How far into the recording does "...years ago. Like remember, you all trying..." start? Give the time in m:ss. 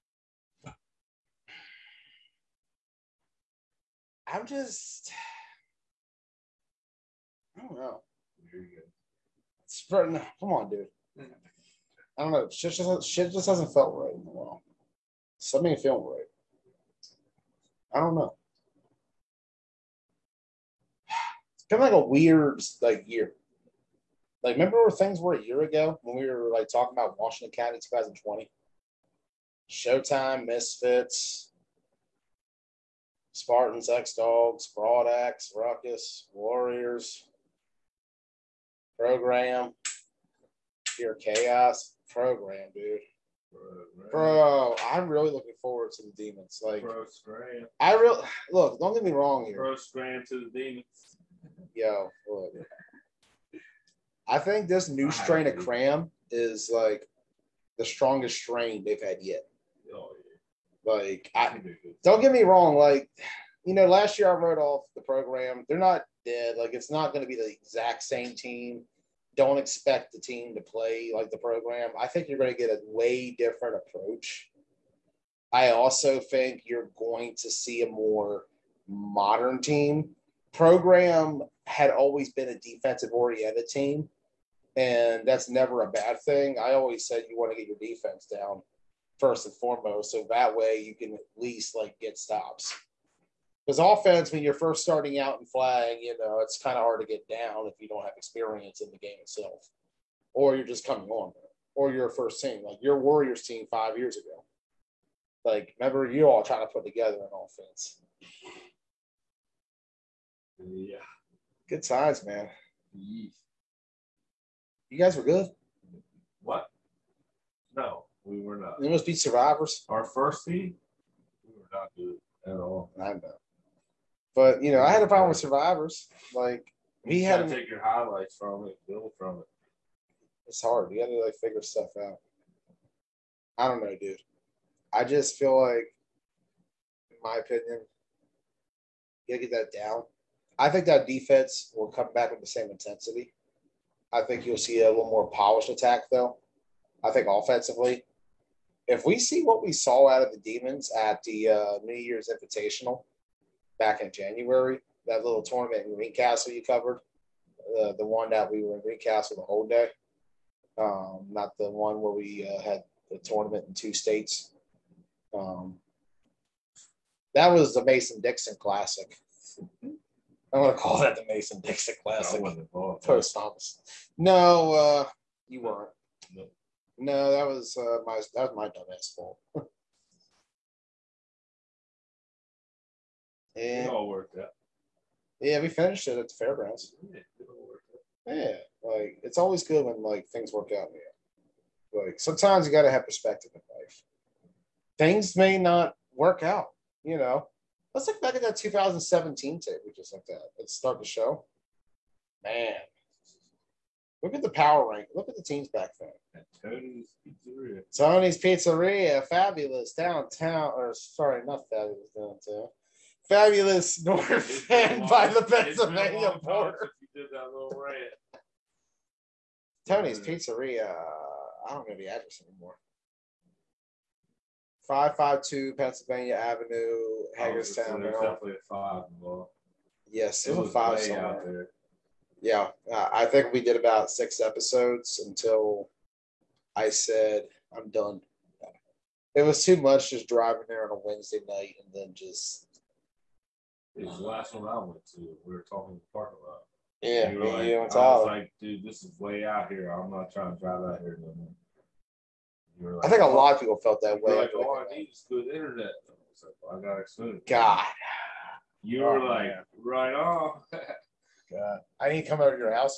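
1:43.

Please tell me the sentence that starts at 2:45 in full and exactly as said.
Um, that was the Mason Dixon Classic.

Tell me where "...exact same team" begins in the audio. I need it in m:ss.
1:07.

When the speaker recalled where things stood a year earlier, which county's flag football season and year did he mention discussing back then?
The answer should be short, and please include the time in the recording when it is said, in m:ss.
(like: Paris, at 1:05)
Washington County 2020, at 0:27.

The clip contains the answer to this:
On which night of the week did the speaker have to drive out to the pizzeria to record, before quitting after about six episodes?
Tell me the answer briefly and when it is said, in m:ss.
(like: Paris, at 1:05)
Wednesday, at 4:01.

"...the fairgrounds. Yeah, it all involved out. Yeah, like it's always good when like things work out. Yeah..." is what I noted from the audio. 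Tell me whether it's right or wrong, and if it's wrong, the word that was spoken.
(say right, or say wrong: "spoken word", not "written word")
wrong: "worked", not "involved".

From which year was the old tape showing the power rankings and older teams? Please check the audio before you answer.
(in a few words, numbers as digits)
2017.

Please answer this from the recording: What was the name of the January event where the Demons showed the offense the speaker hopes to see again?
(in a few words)
New Year's Invitational.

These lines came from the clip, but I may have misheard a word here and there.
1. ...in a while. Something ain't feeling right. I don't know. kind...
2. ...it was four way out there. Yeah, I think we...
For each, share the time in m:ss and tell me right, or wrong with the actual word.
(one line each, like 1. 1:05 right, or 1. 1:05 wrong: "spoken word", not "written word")
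1. 0:14 right
2. 3:50 wrong: "five", not "four".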